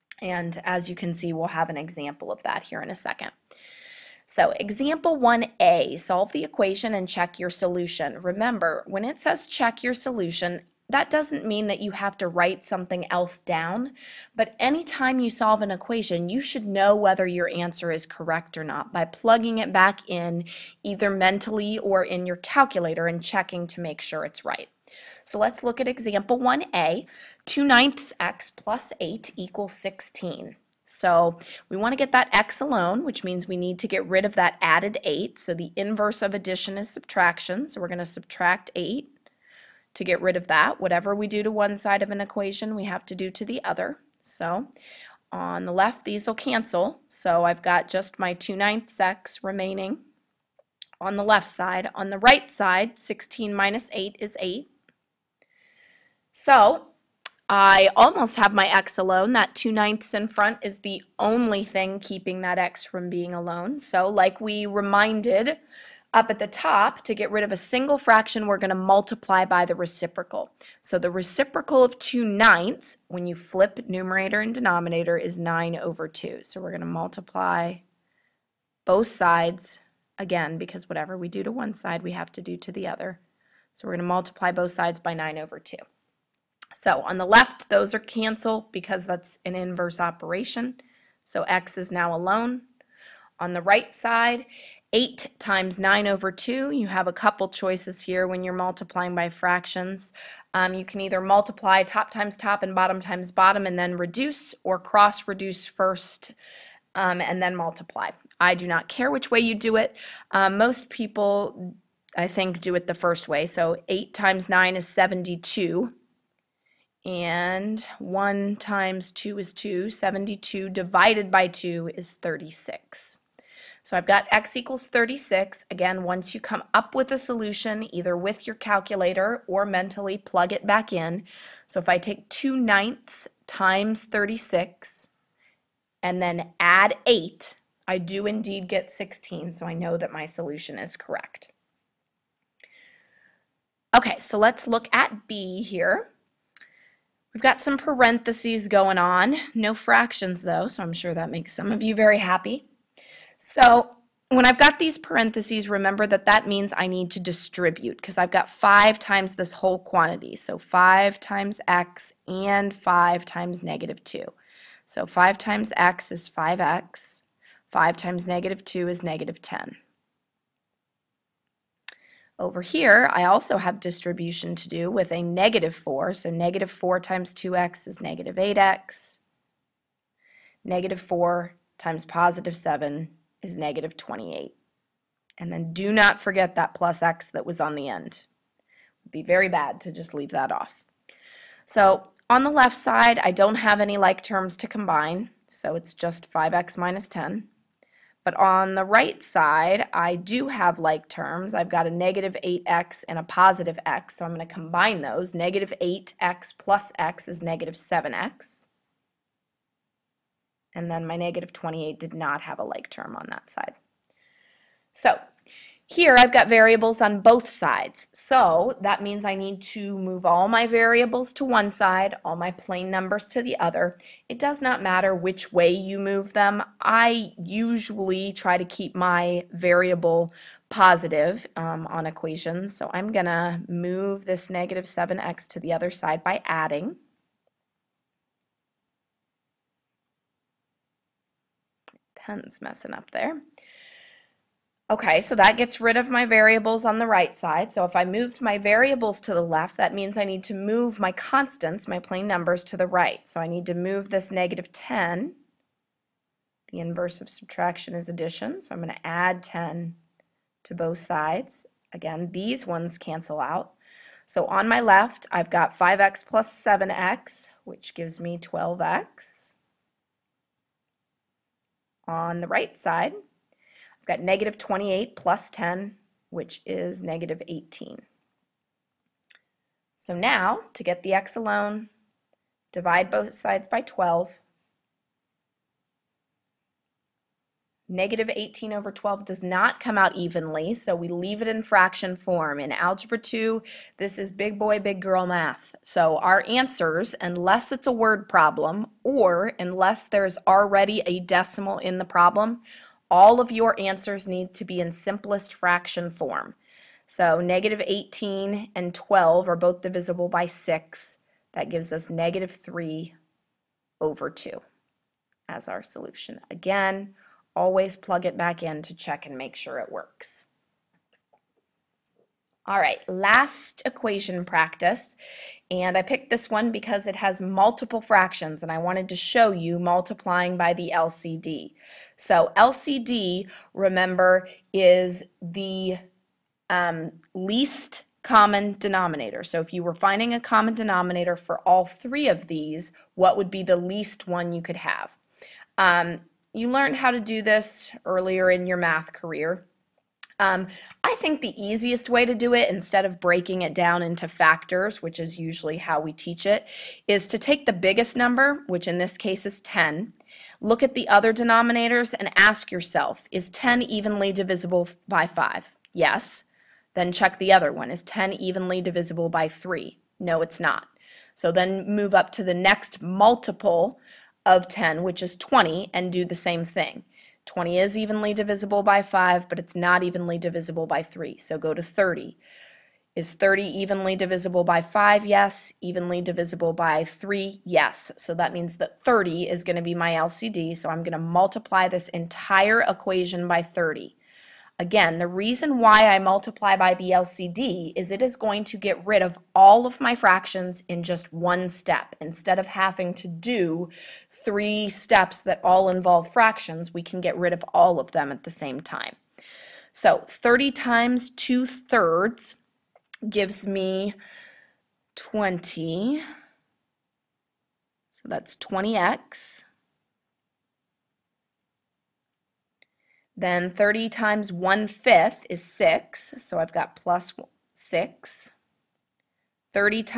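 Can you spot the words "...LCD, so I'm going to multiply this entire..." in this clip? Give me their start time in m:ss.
6:30.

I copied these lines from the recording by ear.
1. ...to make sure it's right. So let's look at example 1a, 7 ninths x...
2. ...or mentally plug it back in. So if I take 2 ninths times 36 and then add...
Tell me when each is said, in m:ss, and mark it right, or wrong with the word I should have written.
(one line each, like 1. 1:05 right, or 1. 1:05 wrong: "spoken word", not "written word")
1. 0:23 wrong: "2", not "7"
2. 2:09 right.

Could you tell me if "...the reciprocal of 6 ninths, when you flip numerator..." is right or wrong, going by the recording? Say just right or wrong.
wrong.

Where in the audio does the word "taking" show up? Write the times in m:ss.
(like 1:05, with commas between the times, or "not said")
not said.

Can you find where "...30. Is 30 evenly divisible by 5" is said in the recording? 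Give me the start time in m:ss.
6:21.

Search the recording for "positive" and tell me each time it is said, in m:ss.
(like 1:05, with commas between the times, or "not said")
3:02, 3:23, 3:50.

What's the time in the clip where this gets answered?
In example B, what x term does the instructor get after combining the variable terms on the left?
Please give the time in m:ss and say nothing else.
4:28.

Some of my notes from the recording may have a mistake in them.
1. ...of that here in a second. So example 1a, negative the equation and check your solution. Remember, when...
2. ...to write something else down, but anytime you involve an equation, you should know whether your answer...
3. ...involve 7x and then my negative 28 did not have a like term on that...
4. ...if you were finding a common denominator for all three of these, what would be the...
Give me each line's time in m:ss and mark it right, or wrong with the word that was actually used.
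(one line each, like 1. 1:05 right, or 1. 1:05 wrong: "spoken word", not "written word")
1. 0:02 wrong: "solve", not "negative"
2. 0:12 wrong: "solve", not "involve"
3. 3:27 wrong: "negative", not "involve"
4. 5:39 right.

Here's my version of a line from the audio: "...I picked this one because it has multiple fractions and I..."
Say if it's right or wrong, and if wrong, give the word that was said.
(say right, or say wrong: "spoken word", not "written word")
right.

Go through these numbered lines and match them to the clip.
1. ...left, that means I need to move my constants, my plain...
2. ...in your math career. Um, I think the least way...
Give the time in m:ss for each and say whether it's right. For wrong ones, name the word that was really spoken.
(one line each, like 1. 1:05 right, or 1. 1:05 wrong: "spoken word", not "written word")
1. 4:09 right
2. 5:48 wrong: "easiest", not "least".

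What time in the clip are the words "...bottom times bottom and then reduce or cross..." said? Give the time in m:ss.
1:42.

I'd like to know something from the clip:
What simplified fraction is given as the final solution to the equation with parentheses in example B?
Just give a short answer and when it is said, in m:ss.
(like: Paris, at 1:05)
-3/2, at 5:12.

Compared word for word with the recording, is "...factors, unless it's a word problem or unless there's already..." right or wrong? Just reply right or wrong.
wrong.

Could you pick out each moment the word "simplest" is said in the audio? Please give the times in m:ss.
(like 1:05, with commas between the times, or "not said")
5:04.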